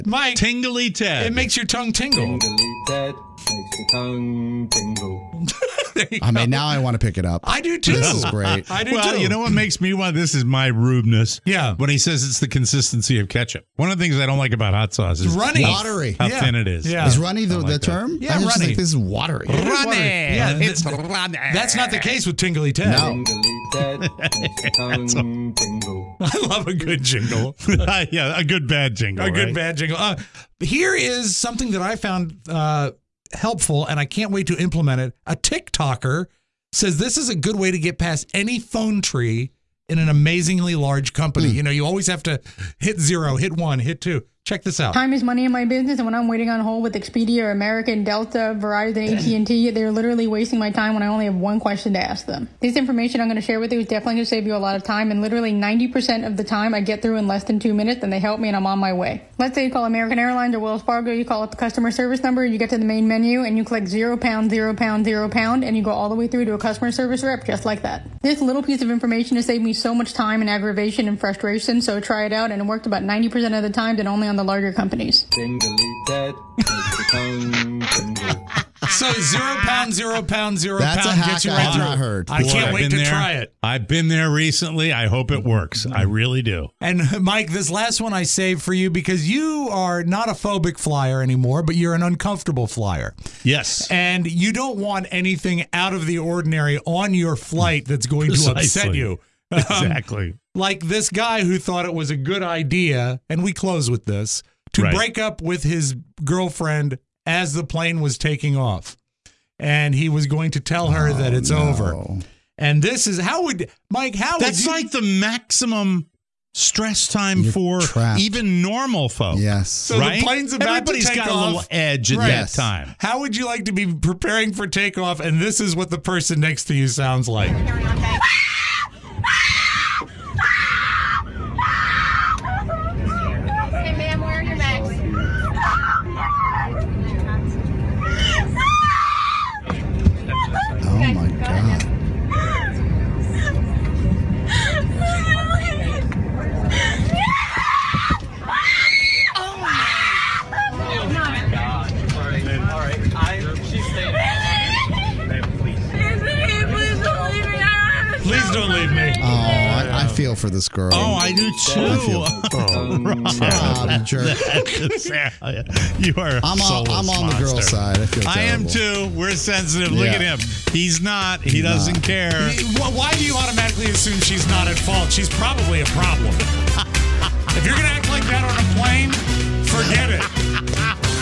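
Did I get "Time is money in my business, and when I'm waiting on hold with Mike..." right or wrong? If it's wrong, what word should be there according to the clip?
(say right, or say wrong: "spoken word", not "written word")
wrong: "Expedia", not "Mike".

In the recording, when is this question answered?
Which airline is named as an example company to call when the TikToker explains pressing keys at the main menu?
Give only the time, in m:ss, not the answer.
0:59.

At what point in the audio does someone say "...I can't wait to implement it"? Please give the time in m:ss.
0:33.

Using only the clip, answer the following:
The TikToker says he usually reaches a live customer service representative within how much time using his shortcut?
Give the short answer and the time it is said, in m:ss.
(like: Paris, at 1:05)
two minutes, at 0:57.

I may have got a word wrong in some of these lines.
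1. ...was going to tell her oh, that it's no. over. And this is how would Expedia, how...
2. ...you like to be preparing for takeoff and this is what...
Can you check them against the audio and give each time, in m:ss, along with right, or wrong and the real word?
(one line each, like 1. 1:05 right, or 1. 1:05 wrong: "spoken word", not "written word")
1. 1:50 wrong: "Mike", not "Expedia"
2. 2:03 right.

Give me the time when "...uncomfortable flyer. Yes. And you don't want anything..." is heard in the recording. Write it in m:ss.
1:32.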